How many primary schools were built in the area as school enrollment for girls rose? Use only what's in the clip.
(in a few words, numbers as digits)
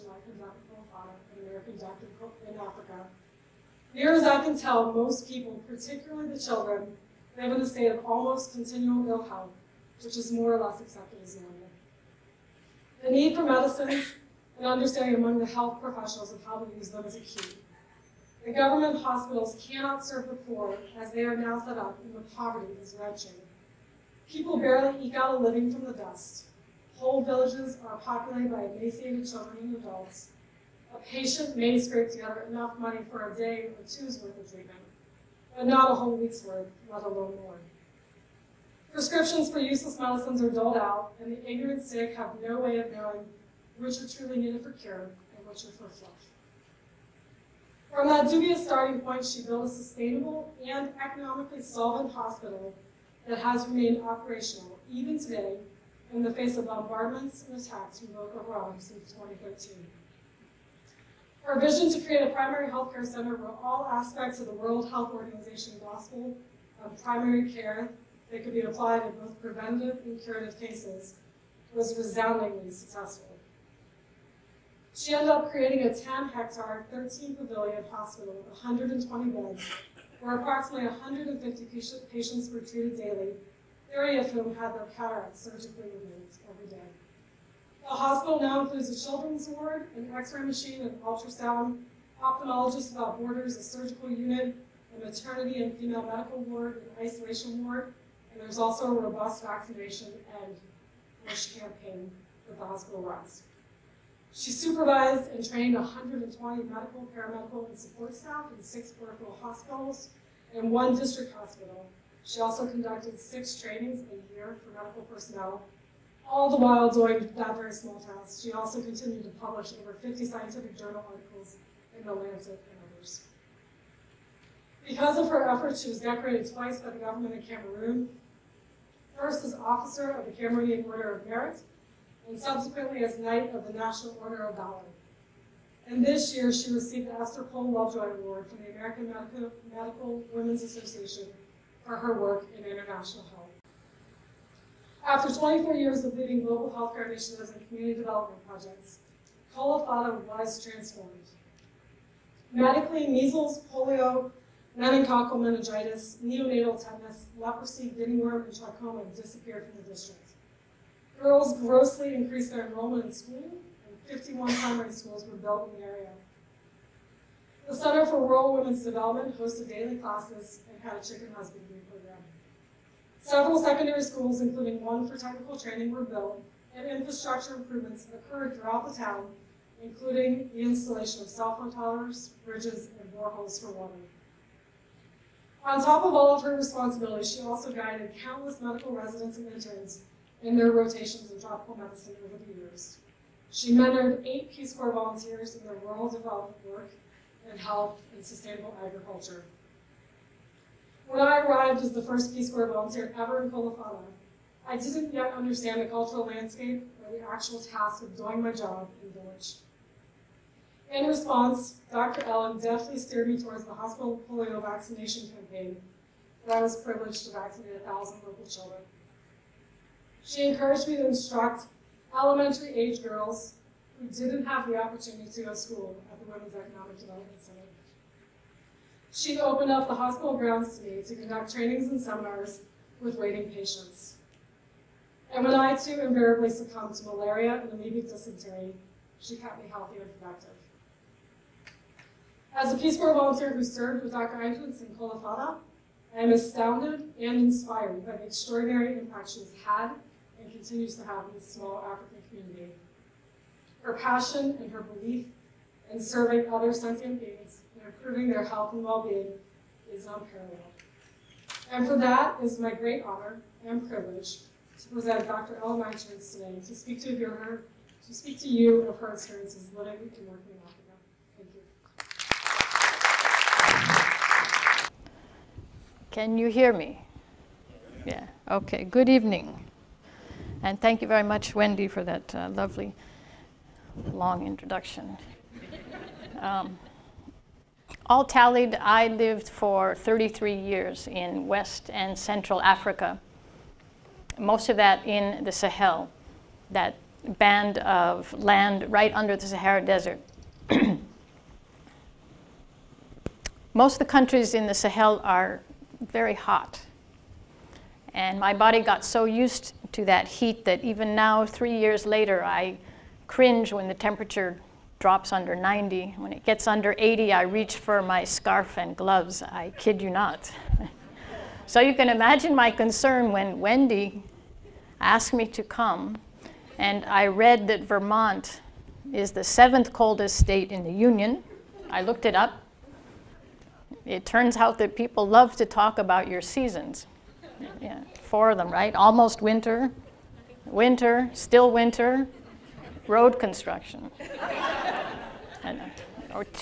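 51.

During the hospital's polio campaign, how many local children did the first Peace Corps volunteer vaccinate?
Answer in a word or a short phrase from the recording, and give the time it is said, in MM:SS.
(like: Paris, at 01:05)
1,000, at 03:37.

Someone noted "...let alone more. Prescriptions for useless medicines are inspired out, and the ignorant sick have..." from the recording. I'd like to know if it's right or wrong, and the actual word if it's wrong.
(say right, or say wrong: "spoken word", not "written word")
wrong: "doled", not "inspired".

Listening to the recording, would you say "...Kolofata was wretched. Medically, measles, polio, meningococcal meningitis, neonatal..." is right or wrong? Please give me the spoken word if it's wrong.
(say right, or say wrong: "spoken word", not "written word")
wrong: "transformed", not "wretched".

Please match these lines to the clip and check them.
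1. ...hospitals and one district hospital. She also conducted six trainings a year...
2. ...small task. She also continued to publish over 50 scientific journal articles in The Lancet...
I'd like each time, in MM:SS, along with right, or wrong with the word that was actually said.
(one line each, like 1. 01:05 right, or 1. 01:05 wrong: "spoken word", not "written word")
1. 01:49 right
2. 01:57 right.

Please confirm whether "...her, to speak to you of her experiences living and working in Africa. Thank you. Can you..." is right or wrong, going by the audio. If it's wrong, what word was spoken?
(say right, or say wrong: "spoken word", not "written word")
right.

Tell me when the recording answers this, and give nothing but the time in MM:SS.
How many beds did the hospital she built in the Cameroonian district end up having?
01:18.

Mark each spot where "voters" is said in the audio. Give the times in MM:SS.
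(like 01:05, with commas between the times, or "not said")
not said.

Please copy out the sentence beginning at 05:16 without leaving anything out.
When it gets under 80, I reach for my scarf and gloves.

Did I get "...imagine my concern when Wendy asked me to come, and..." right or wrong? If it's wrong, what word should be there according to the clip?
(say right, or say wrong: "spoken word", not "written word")
right.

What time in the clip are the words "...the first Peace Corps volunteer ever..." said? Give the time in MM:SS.
03:21.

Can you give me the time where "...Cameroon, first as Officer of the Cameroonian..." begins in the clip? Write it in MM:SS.
02:07.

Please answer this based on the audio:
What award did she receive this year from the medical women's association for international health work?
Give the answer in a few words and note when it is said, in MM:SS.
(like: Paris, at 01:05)
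Esther Pohl Lovejoy Award, at 02:17.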